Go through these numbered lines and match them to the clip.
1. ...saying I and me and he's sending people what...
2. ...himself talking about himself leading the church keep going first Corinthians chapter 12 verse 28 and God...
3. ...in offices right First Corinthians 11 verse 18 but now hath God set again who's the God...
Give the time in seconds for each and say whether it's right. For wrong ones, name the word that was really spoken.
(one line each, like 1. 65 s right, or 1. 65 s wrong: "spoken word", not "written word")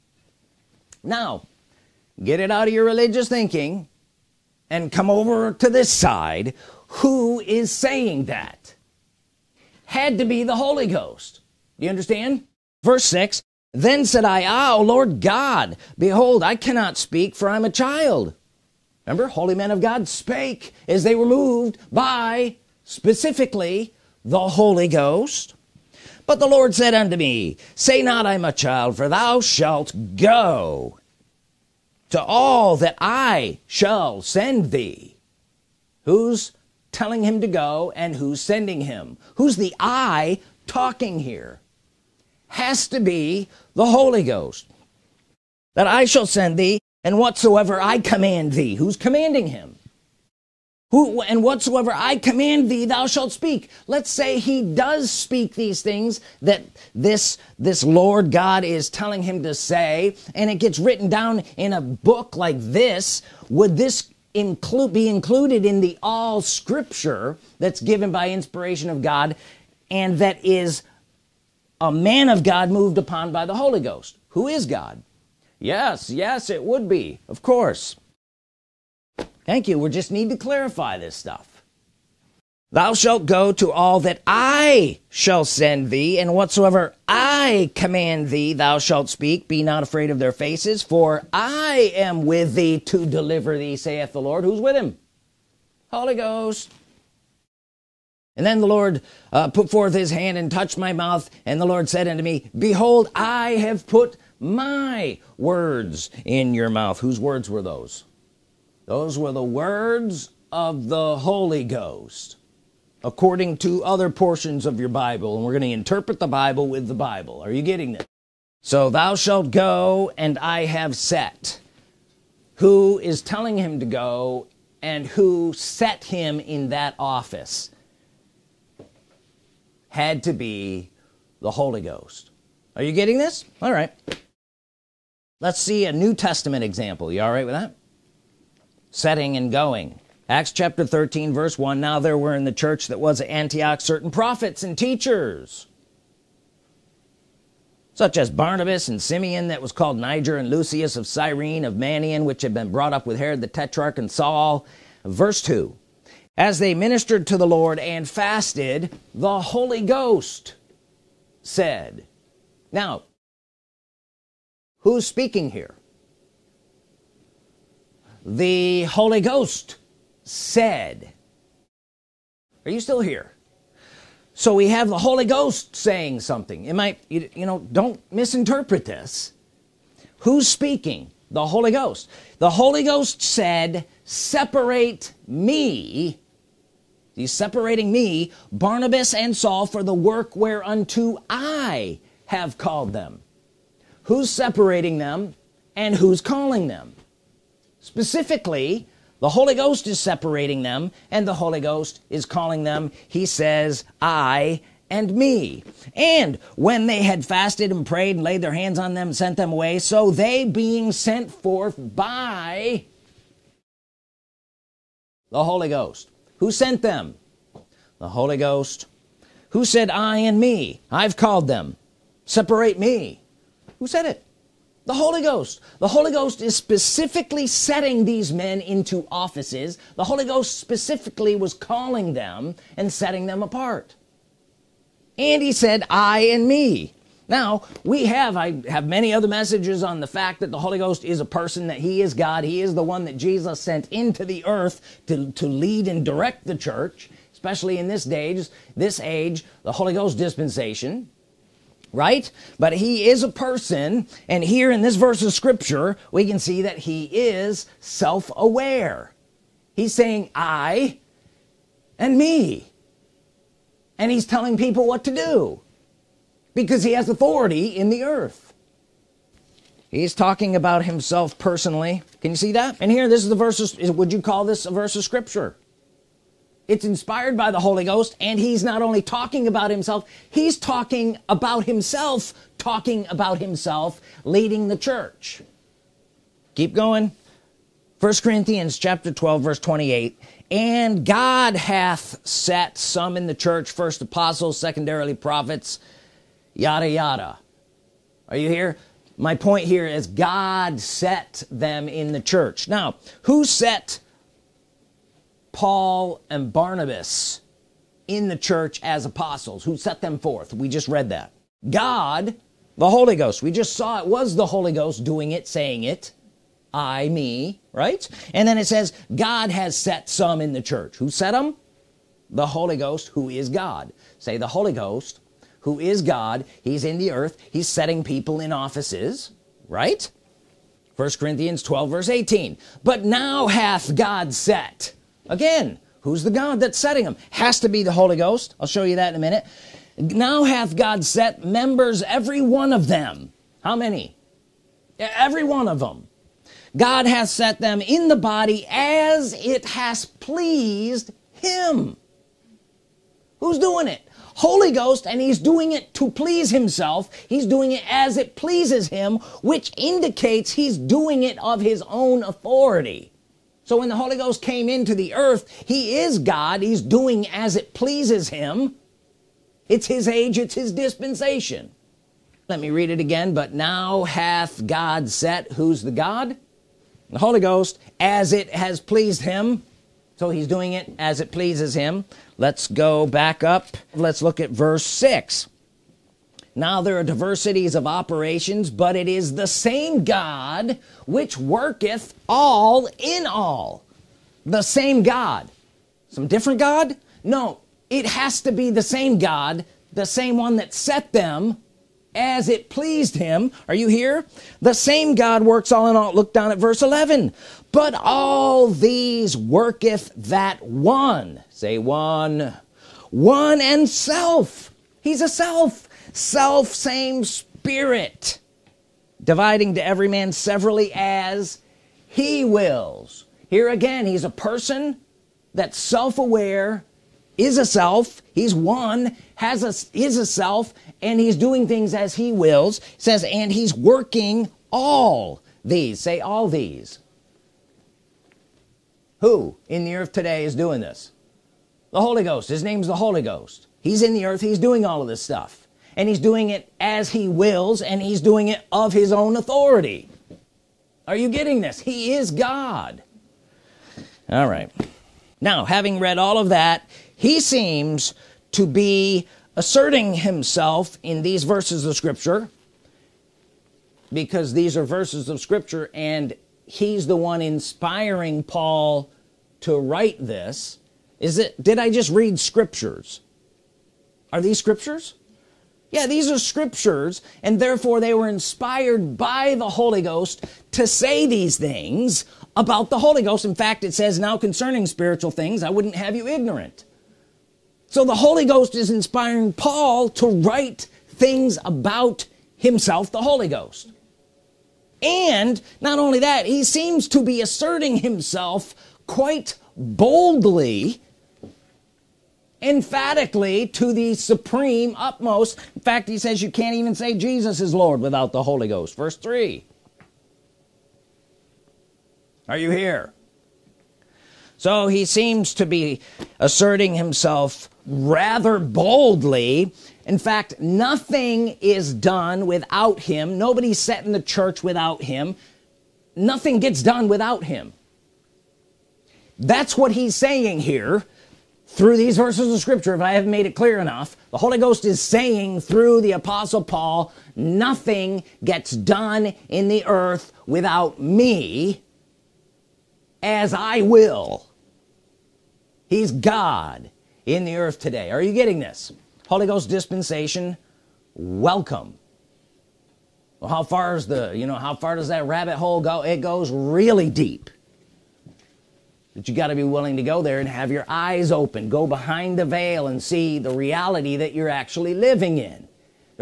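1. 259 s wrong: "telling", not "sending"
2. 281 s right
3. 328 s wrong: "12", not "11".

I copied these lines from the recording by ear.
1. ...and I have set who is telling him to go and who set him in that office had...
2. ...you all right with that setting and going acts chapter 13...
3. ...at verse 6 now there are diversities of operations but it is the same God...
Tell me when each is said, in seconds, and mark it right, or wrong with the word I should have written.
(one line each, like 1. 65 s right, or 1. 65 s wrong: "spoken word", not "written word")
1. 120 s right
2. 137 s right
3. 384 s right.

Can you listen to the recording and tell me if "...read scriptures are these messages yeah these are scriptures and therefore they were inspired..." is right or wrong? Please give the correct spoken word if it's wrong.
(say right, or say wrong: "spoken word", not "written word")
wrong: "scriptures", not "messages".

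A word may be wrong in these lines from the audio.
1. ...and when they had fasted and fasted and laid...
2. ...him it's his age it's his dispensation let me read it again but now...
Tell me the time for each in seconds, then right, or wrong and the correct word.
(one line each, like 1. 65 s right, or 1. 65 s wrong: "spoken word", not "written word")
1. 205 s wrong: "prayed", not "fasted"
2. 368 s right.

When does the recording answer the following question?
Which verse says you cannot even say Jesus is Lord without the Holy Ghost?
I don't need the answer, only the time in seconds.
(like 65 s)
508 s.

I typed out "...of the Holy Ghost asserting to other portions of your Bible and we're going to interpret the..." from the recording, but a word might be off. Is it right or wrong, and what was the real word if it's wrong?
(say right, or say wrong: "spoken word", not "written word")
wrong: "according", not "asserting".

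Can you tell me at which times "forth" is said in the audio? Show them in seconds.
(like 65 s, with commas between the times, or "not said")
99 s, 211 s, 310 s.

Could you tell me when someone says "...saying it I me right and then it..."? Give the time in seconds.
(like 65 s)
315 s.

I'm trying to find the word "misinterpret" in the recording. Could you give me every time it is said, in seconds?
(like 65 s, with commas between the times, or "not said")
178 s.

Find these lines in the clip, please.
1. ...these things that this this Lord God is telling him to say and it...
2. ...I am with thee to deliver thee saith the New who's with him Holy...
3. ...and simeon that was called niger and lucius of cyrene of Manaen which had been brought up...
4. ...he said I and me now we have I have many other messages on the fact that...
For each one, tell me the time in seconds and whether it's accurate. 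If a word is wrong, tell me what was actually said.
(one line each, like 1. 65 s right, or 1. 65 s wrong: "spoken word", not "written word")
1. 55 s right
2. 91 s wrong: "Lord", not "New"
3. 148 s right
4. 235 s right.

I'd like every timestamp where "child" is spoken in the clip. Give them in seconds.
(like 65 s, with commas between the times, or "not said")
17 s, 28 s.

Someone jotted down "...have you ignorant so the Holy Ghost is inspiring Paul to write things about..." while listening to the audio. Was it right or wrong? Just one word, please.
right.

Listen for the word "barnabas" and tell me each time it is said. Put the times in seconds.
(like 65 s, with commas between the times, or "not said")
148 s, 188 s, 306 s.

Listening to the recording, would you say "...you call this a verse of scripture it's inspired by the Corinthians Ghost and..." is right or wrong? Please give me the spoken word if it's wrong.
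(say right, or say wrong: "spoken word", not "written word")
wrong: "Holy", not "Corinthians".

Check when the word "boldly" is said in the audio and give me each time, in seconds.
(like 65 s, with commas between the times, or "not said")
499 s, 518 s.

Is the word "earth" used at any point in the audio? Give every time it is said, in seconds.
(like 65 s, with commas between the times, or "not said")
244 s, 268 s, 327 s, 365 s, 439 s, 444 s, 539 s, 547 s.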